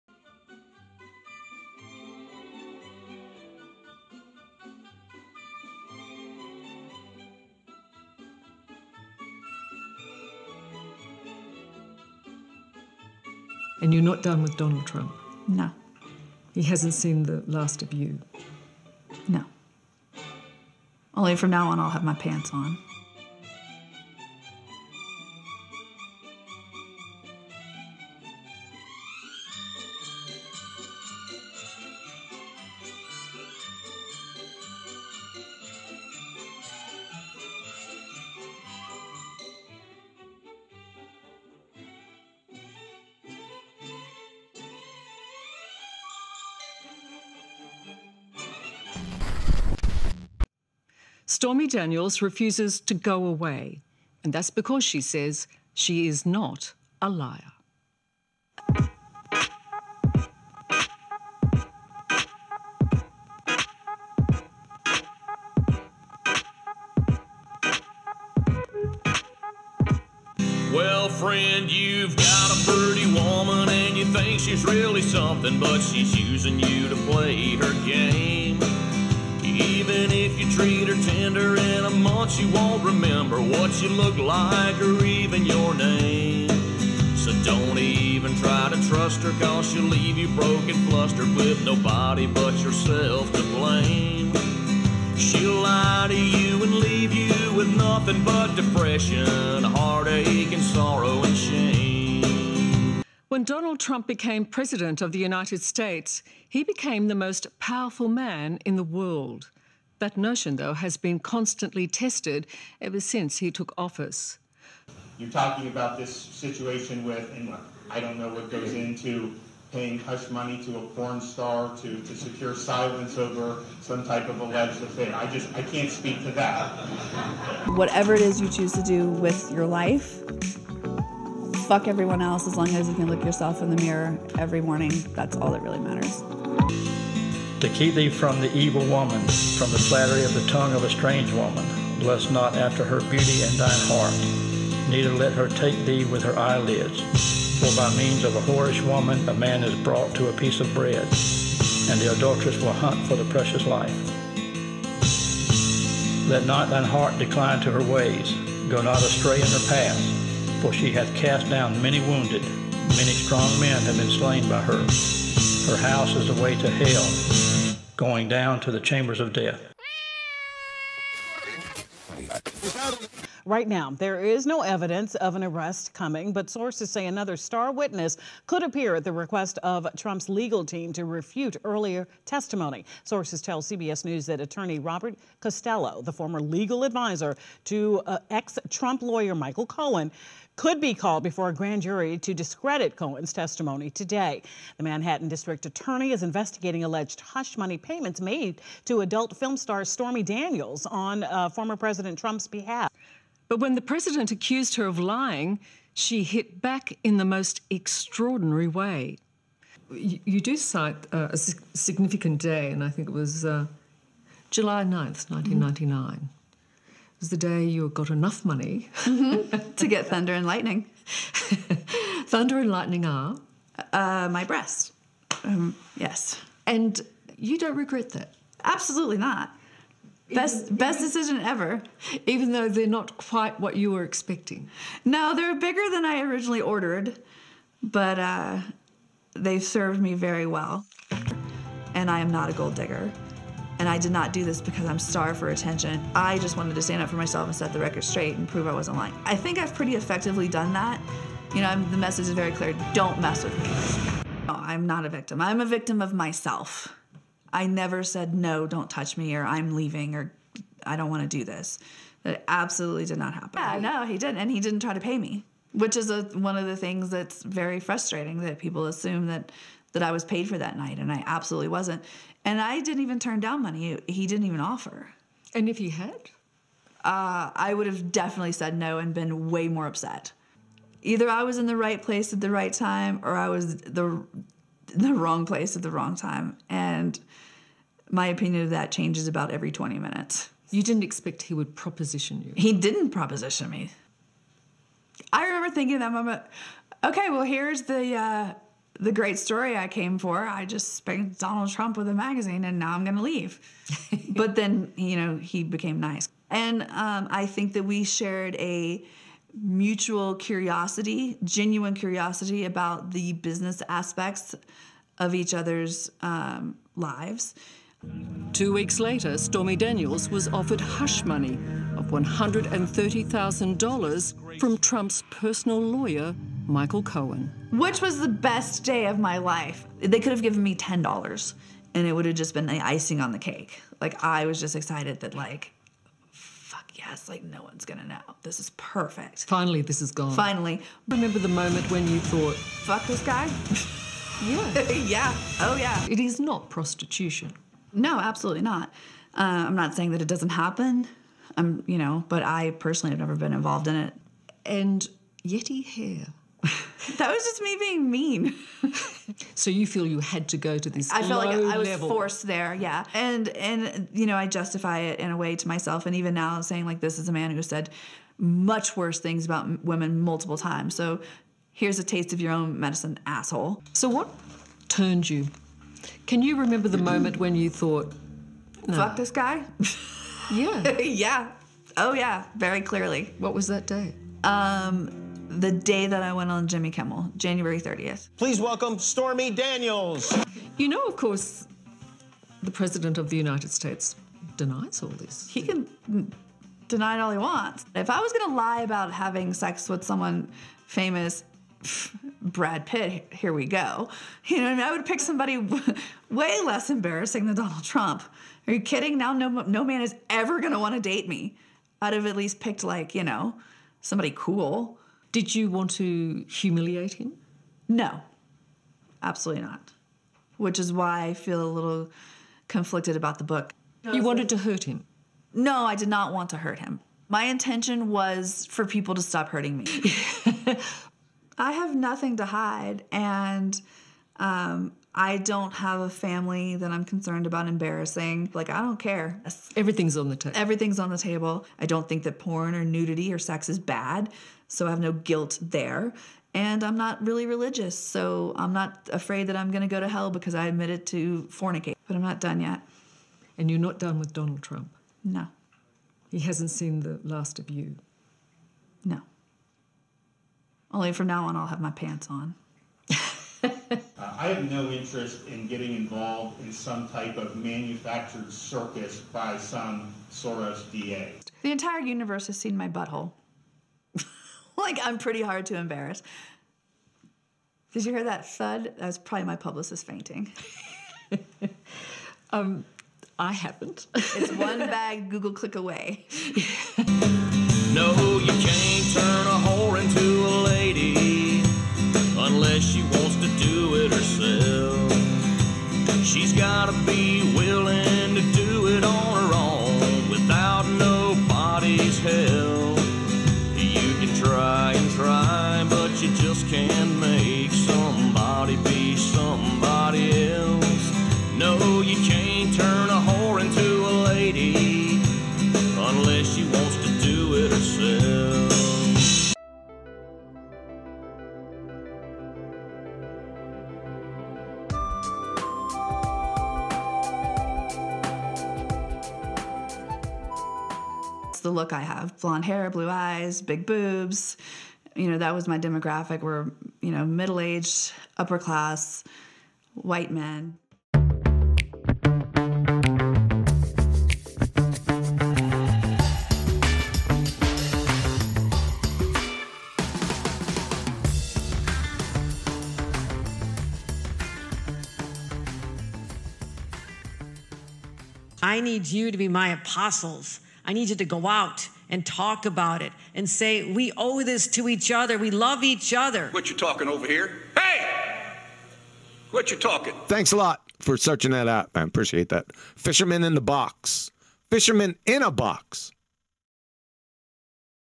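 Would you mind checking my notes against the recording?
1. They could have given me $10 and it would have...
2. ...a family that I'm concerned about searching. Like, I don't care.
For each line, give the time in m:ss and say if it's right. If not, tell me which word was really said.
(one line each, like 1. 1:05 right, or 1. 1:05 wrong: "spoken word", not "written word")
1. 5:29 right
2. 7:16 wrong: "embarrassing", not "searching".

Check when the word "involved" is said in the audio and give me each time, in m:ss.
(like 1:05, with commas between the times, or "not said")
5:53, 7:45.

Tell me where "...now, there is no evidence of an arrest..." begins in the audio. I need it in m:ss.
2:53.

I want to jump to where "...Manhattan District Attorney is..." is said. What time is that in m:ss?
3:14.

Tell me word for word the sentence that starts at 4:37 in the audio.
Uh, I would have definitely said no and been way more upset.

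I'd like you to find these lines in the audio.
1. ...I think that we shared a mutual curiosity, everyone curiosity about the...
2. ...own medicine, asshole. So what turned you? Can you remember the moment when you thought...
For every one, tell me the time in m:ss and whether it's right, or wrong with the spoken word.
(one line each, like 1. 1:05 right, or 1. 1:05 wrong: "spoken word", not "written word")
1. 5:07 wrong: "genuine", not "everyone"
2. 6:12 right.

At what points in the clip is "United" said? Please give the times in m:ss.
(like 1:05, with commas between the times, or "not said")
1:45, 6:33.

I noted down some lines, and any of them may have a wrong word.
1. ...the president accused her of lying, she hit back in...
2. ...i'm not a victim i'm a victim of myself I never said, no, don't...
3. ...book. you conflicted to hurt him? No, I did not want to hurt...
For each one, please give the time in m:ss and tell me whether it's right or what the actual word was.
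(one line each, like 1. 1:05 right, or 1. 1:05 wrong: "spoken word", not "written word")
1. 3:23 right
2. 4:14 right
3. 7:03 wrong: "wanted", not "conflicted".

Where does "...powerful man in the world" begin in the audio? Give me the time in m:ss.
1:47.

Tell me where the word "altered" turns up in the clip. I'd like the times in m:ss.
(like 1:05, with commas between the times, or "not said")
not said.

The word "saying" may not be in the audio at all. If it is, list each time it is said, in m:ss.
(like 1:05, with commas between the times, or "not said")
5:49, 6:06.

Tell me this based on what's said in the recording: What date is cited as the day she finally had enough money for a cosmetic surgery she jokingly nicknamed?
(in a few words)
July 9th, 1999.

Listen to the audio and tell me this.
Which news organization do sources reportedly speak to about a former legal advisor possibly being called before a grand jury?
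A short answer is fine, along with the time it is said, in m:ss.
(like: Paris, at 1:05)
CBS News, at 3:03.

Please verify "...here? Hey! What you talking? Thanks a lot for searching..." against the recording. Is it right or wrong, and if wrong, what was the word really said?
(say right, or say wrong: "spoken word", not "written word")
right.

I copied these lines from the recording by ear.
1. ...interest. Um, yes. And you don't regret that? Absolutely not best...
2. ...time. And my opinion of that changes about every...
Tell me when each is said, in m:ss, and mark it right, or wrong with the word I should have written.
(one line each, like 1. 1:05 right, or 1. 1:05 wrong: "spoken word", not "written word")
1. 3:44 wrong: "breast", not "interest"
2. 4:46 right.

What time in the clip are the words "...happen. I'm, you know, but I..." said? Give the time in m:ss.
5:50.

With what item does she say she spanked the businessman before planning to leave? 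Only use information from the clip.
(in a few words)
A magazine.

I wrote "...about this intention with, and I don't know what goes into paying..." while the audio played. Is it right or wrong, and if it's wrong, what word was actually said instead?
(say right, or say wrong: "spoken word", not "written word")
wrong: "situation", not "intention".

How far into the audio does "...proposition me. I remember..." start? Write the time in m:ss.
4:53.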